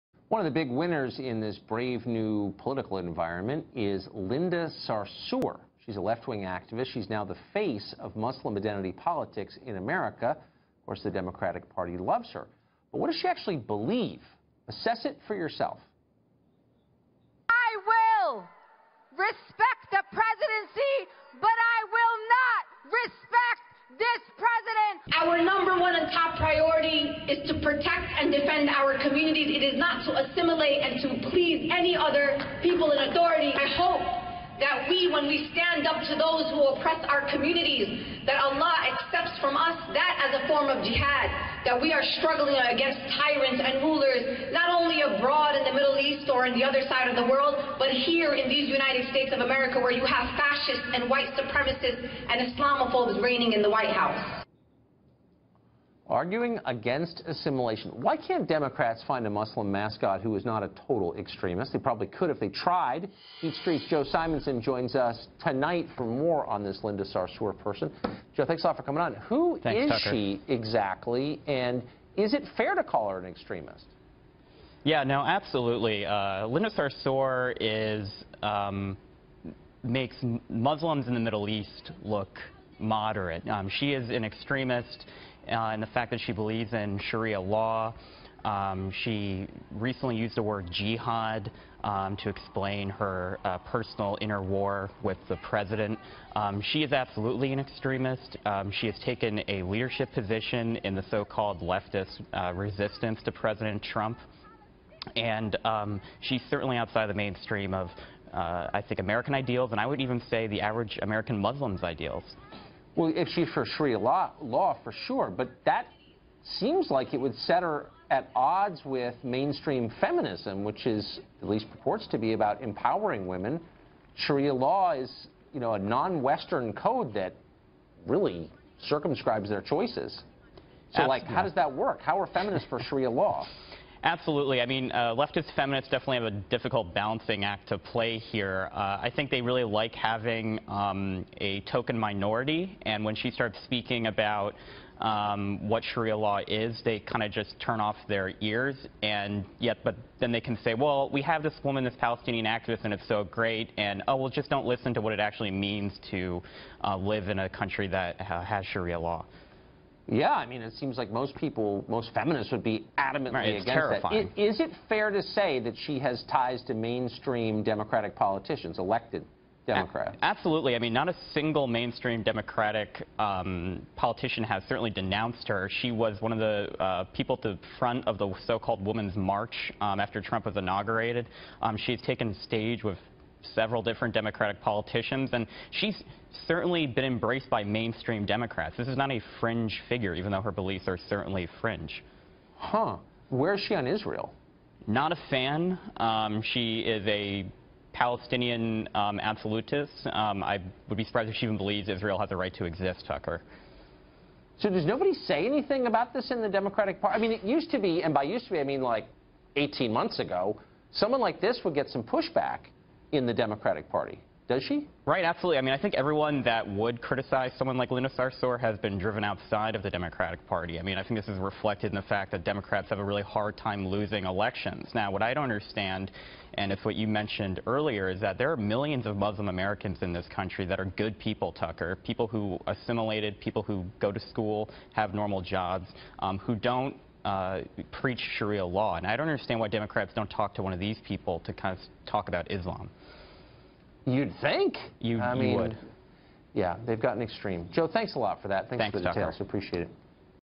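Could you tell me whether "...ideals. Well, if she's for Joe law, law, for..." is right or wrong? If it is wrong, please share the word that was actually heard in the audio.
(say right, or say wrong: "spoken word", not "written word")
wrong: "Sharia", not "Joe".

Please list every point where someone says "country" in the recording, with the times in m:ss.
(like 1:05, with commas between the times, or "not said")
2:37, 3:50.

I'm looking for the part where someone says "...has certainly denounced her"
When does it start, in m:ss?
2:54.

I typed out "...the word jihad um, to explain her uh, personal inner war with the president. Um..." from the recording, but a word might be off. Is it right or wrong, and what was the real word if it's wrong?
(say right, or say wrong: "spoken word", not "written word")
right.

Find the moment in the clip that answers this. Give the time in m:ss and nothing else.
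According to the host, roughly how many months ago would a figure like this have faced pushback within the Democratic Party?
3:29.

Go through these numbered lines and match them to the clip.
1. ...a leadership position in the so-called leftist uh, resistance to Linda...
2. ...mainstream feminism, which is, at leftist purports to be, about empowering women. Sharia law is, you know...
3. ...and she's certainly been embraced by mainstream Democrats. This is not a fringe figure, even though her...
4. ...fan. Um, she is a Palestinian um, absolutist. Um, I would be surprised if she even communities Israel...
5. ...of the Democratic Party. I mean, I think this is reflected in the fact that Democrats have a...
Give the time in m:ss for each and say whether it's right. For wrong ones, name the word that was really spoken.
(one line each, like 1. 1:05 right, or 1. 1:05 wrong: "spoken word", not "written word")
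1. 1:39 wrong: "President", not "Linda"
2. 1:59 wrong: "least", not "leftist"
3. 3:05 right
4. 3:15 wrong: "believes", not "communities"
5. 3:39 right.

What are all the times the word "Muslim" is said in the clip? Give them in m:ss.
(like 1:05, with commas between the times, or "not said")
0:08, 0:59, 1:20, 1:51, 3:49.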